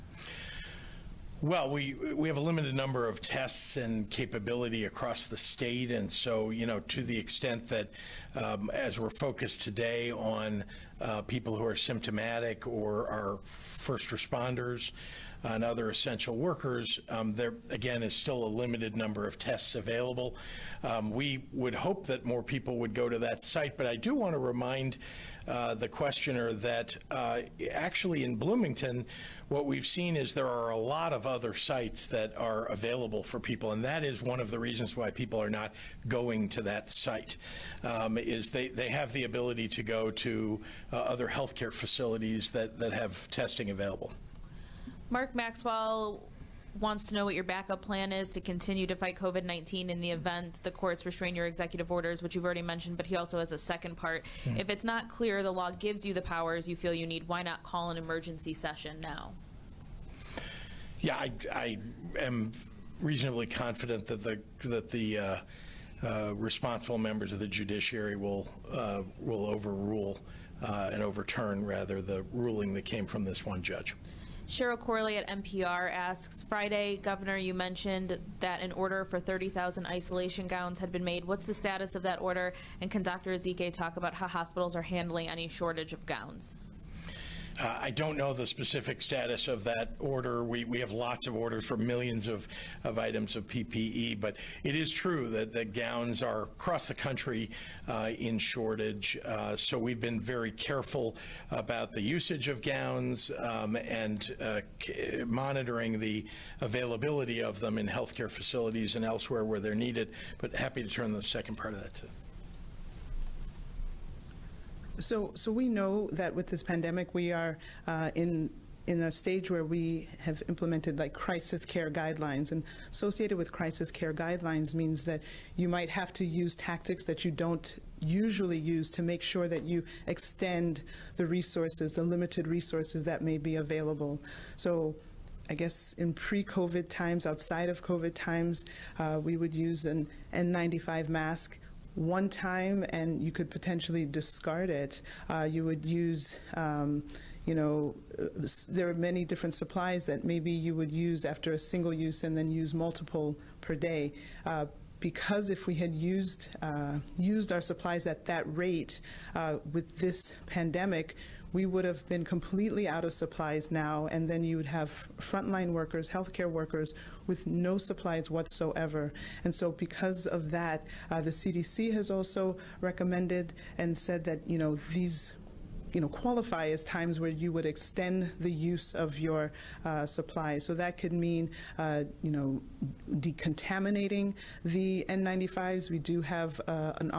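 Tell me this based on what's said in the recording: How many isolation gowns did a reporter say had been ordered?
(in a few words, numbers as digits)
30,000.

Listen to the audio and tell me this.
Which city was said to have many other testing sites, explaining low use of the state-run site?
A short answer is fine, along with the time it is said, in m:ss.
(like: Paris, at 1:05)
Bloomington, at 0:28.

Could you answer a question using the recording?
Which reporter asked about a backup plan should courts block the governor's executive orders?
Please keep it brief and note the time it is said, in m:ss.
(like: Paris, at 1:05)
Mark Maxwell, at 0:45.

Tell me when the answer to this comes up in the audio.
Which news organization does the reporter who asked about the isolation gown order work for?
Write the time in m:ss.
1:15.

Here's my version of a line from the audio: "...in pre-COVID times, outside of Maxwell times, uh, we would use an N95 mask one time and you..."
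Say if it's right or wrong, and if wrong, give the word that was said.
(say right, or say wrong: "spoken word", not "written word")
wrong: "COVID", not "Maxwell".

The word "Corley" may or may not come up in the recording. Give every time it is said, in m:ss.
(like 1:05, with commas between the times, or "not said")
1:14.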